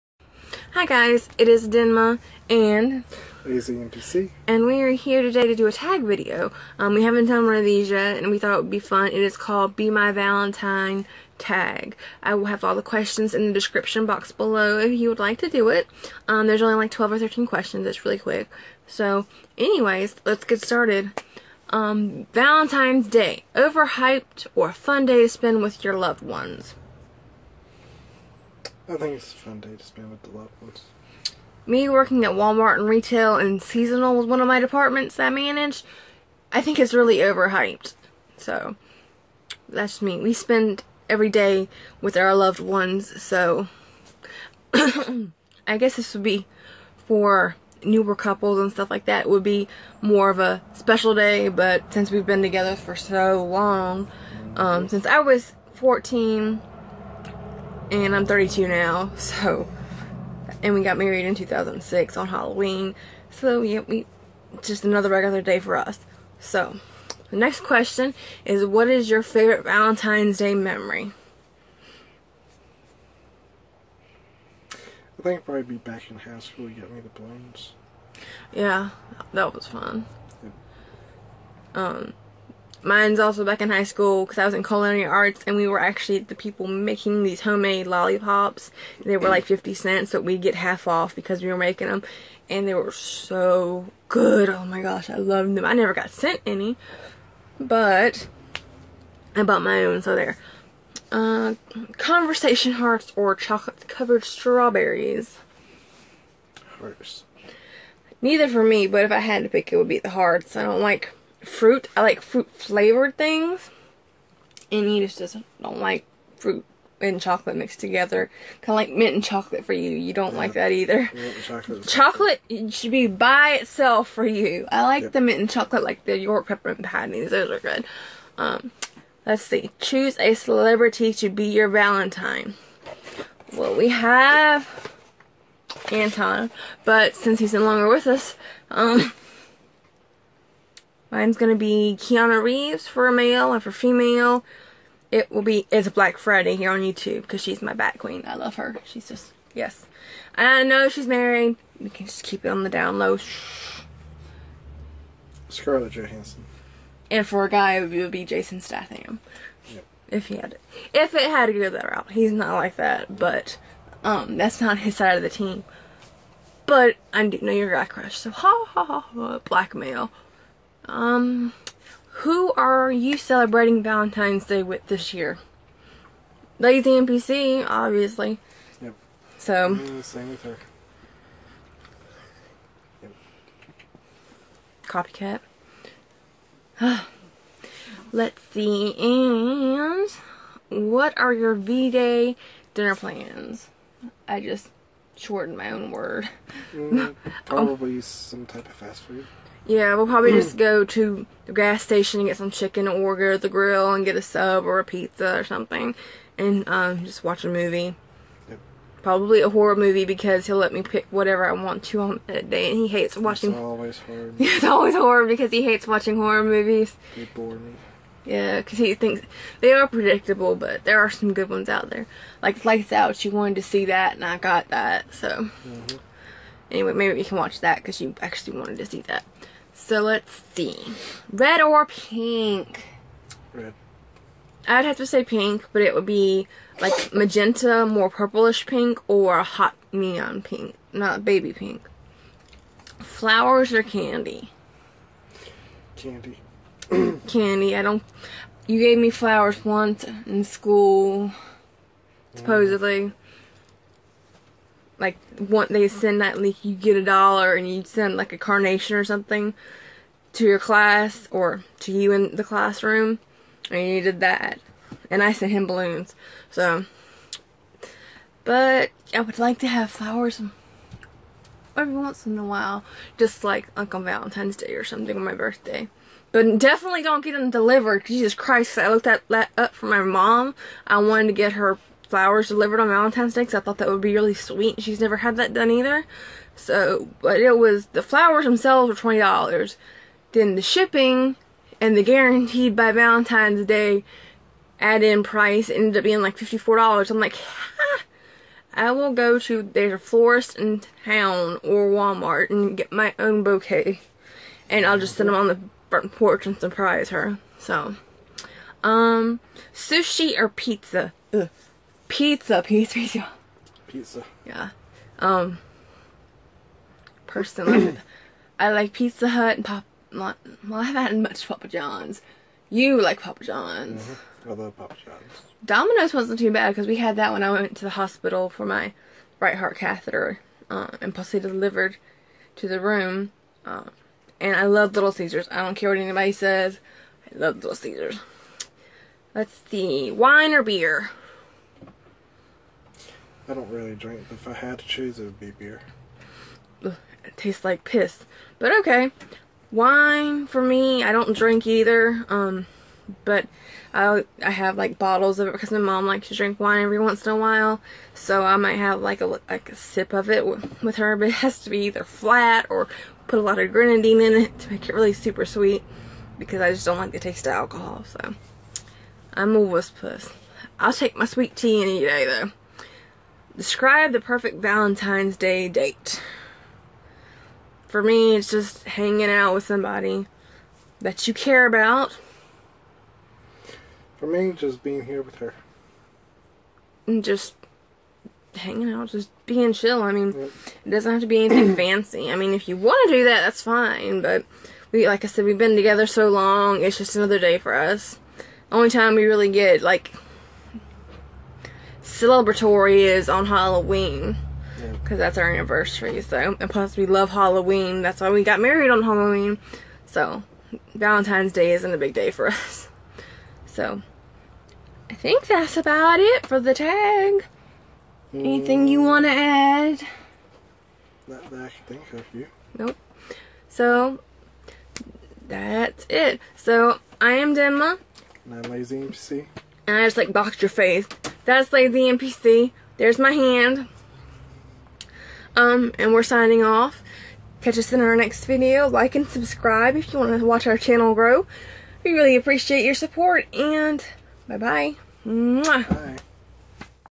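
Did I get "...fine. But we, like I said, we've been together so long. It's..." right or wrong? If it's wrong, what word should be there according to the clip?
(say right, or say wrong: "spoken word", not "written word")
right.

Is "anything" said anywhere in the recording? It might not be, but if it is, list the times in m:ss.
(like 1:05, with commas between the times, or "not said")
6:31, 6:58.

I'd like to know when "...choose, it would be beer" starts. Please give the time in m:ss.
5:44.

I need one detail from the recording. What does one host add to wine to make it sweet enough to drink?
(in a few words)
grenadine.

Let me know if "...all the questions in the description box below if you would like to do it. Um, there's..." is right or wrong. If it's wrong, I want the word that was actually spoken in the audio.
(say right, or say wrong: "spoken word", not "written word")
right.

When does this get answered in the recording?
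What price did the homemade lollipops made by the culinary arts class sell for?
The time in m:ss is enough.
1:29.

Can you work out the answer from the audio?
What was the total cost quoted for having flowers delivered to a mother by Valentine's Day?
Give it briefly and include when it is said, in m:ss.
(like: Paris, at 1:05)
$54, at 4:56.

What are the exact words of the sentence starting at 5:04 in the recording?
And I'll just sit them on the front porch and surprise her.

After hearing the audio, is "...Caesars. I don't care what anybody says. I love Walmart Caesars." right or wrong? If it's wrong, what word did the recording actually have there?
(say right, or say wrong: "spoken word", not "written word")
wrong: "Little", not "Walmart".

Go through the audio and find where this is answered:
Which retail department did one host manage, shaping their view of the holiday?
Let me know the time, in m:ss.
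0:33.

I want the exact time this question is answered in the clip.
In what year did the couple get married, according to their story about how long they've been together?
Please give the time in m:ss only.
1:01.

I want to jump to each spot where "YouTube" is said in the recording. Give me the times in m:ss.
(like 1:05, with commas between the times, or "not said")
2:26.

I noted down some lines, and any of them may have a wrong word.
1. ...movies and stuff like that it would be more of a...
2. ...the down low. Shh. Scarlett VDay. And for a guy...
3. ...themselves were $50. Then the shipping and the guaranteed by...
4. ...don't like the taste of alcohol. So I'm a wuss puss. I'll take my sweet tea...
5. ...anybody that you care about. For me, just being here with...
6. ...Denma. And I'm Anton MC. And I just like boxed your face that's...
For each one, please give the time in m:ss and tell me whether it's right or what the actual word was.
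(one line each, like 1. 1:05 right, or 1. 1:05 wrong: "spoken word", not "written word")
1. 0:48 wrong: "couples", not "movies"
2. 2:32 wrong: "Johansson", not "VDay"
3. 4:48 wrong: "20", not "50"
4. 6:06 right
5. 6:19 wrong: "somebody", not "anybody"
6. 7:07 wrong: "Lazy", not "Anton".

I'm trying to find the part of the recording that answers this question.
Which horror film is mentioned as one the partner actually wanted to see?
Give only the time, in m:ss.
3:42.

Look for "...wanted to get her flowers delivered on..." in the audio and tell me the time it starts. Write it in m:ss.
4:40.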